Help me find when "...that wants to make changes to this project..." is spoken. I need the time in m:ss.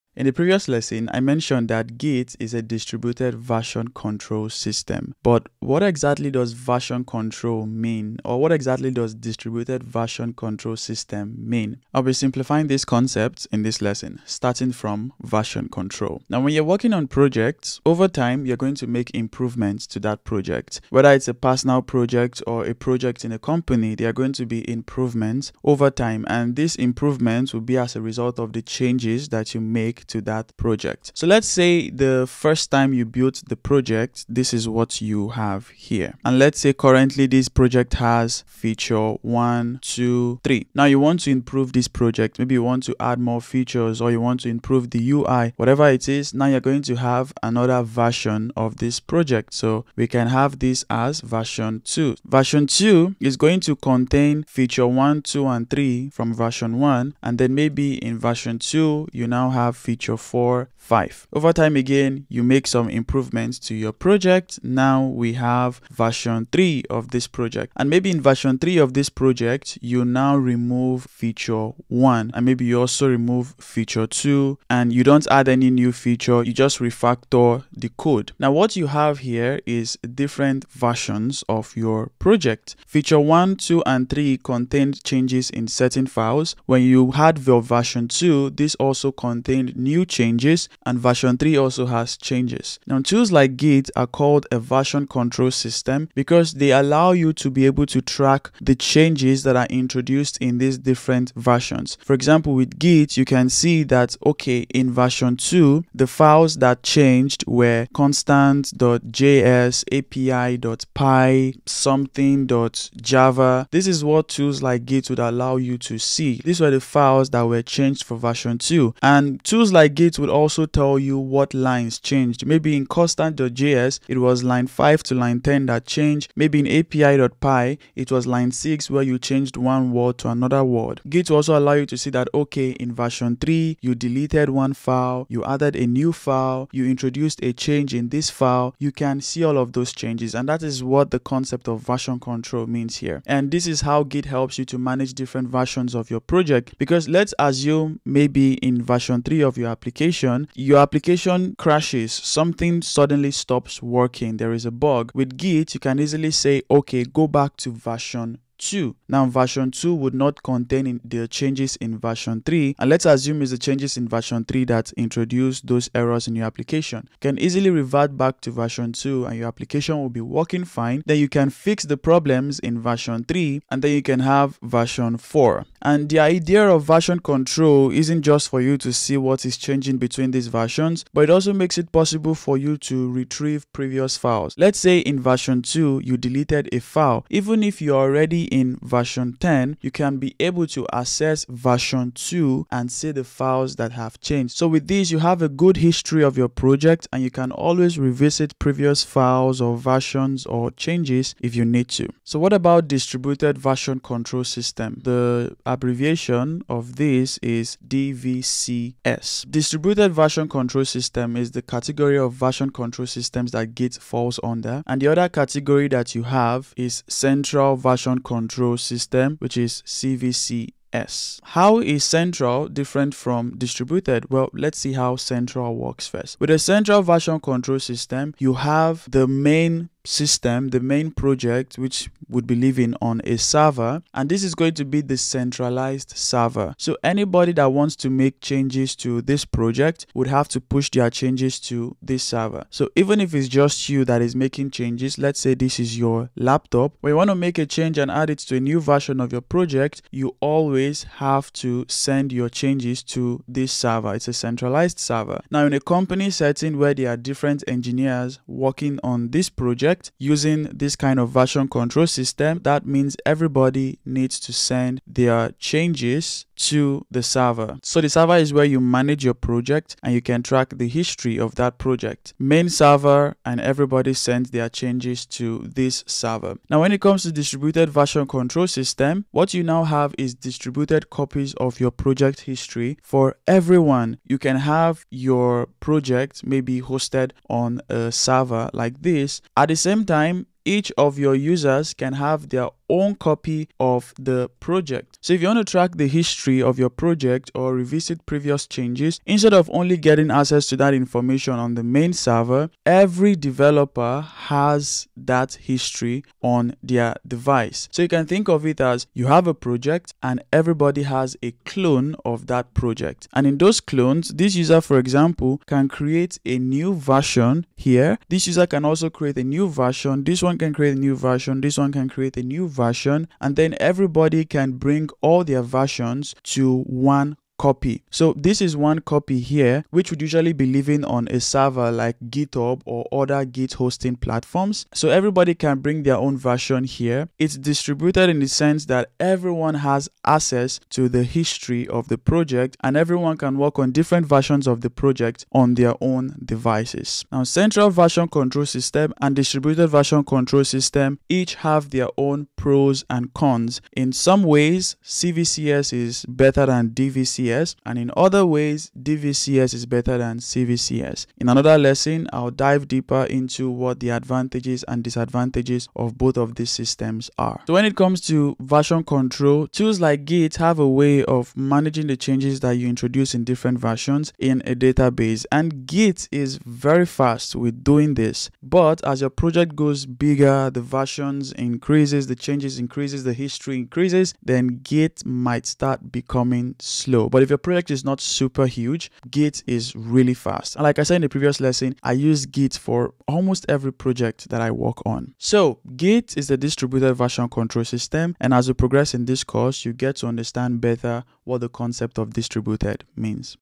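3:57.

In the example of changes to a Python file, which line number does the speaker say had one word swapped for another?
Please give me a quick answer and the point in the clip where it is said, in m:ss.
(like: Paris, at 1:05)
line 6, at 2:08.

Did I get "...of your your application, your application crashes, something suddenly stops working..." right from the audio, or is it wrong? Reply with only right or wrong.
right.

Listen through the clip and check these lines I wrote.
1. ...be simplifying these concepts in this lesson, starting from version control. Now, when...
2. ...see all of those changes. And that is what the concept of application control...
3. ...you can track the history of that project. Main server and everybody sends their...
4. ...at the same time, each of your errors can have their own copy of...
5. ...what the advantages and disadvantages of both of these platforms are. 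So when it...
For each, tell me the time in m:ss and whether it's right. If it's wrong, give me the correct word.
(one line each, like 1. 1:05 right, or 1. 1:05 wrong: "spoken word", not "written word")
1. 0:12 right
2. 2:19 wrong: "version", not "application"
3. 4:30 right
4. 4:49 wrong: "users", not "errors"
5. 6:03 wrong: "systems", not "platforms".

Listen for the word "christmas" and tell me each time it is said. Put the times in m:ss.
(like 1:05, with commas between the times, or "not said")
not said.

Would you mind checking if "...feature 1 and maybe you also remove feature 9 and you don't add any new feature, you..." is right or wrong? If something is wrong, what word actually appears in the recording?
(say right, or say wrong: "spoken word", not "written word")
wrong: "2", not "9".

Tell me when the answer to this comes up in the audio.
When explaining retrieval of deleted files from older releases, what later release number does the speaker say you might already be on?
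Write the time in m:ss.
3:08.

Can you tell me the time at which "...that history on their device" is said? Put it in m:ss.
5:05.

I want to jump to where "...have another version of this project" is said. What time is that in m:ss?
0:46.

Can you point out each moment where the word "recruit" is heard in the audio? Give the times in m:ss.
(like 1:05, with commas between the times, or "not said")
not said.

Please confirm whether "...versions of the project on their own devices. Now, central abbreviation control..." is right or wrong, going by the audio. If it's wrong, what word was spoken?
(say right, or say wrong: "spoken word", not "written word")
wrong: "version", not "abbreviation".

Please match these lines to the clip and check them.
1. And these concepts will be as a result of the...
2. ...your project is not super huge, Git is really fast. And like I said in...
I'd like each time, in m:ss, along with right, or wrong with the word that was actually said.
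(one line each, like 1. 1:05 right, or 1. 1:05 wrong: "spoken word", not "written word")
1. 0:26 wrong: "improvements", not "concepts"
2. 6:27 right.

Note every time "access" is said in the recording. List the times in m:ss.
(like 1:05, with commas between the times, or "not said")
3:10, 5:00, 5:40.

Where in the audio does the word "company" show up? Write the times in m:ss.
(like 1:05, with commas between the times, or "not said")
0:23, 4:15.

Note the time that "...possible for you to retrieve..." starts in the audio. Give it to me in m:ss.
3:01.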